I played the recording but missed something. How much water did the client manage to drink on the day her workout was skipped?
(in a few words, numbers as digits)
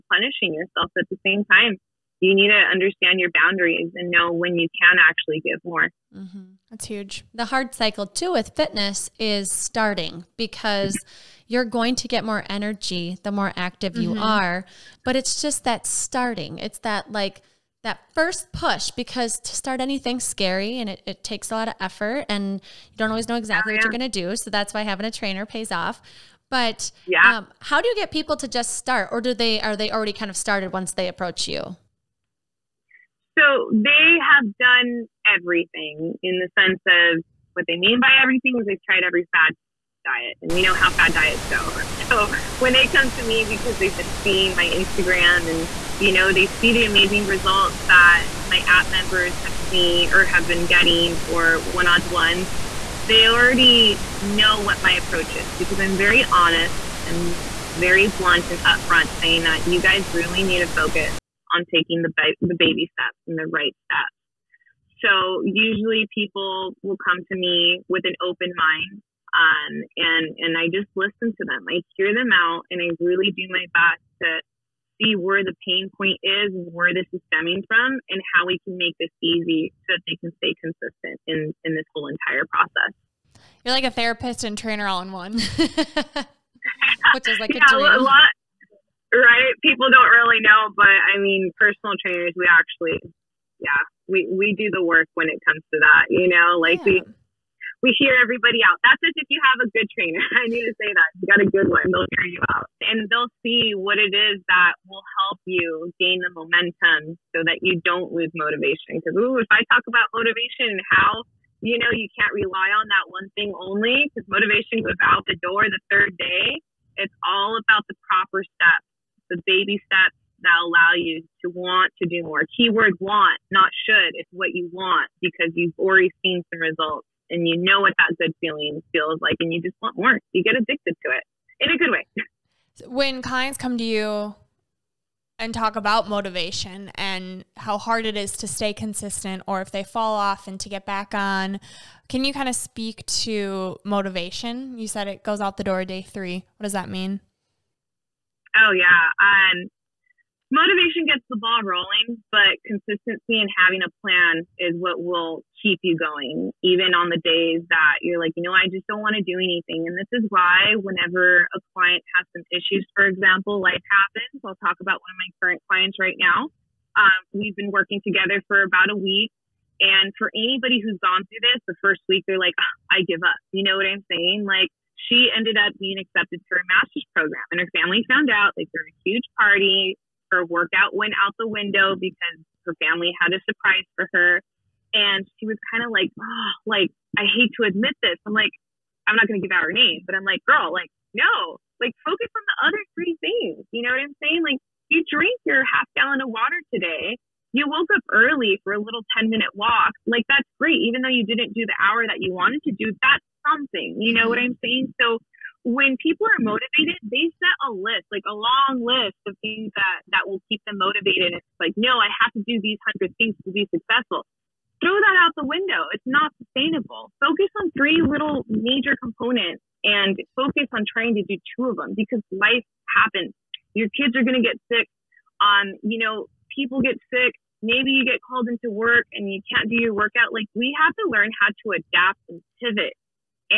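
half gallon.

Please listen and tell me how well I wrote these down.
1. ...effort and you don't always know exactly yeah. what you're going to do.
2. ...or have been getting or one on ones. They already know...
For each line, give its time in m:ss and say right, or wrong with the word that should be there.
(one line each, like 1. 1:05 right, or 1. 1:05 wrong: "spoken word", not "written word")
1. 0:21 right
2. 0:50 right.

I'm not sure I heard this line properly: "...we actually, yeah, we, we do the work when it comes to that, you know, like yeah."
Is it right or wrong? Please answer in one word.
right.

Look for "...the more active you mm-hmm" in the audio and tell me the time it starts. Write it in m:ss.
0:13.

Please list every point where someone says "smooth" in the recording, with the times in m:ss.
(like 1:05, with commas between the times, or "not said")
not said.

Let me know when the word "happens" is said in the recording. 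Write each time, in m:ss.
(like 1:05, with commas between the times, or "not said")
2:43, 3:42.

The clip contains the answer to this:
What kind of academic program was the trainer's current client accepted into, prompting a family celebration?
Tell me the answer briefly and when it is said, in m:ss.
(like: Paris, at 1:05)
master's program, at 2:56.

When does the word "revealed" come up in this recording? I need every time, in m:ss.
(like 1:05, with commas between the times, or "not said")
not said.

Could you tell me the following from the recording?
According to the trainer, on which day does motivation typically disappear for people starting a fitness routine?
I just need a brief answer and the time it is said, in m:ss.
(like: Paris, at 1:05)
third day, at 1:55.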